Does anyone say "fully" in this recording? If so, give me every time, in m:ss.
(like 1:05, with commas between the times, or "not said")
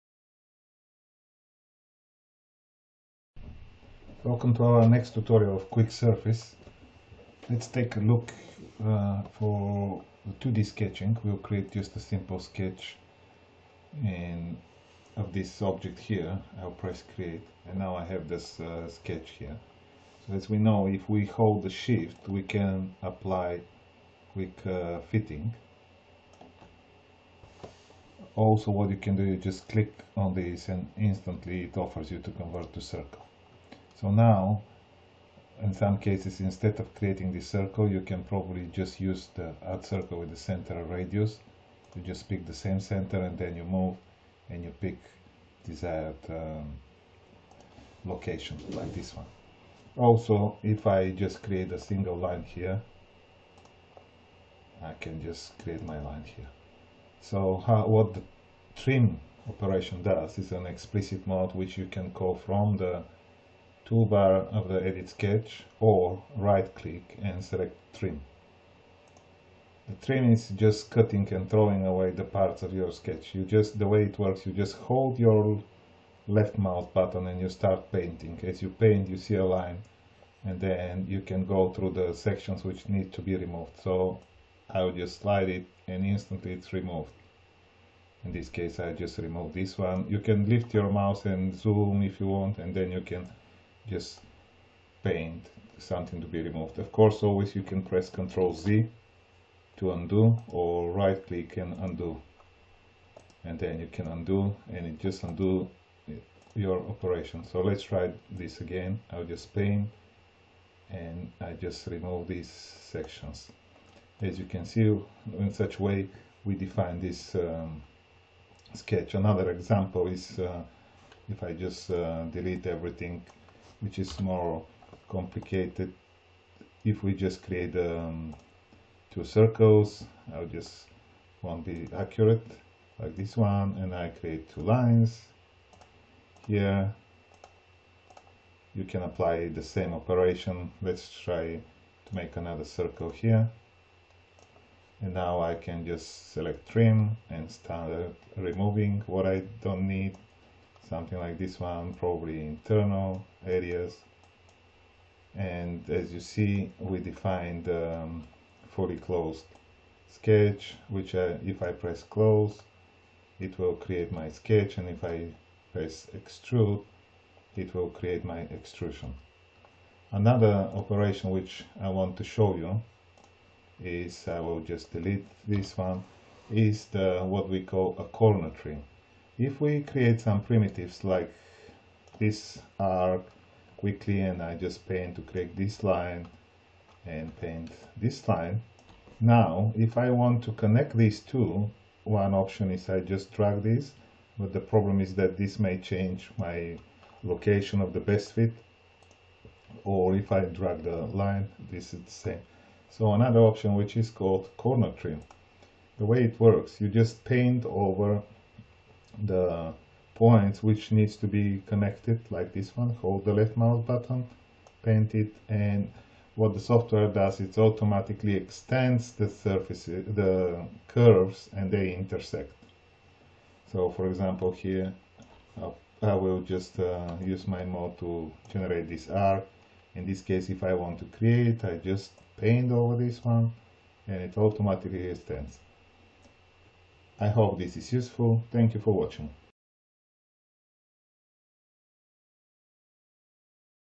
2:38.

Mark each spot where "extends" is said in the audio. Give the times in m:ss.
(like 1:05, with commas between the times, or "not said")
3:38, 3:55.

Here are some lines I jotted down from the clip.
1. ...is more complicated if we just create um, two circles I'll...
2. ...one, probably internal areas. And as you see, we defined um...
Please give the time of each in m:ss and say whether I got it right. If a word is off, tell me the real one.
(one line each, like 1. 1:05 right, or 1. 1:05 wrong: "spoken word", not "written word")
1. 2:03 right
2. 2:31 right.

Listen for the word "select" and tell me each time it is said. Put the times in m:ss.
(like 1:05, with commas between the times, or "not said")
1:07, 2:26.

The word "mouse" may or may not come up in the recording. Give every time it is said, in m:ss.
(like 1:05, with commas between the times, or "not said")
1:16, 1:30, 3:33.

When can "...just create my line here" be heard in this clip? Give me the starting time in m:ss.
0:55.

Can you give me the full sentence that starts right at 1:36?
Of course, always you can press Ctrl Z to undo or right click and undo.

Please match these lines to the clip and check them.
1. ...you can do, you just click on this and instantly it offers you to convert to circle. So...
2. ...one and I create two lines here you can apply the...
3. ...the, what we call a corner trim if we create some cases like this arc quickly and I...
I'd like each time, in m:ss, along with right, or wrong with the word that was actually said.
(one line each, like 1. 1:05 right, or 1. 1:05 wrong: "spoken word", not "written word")
1. 0:28 right
2. 2:13 right
3. 2:56 wrong: "primitives", not "cases".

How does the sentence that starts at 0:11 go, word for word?
We'll create just a simple sketch and of this object here.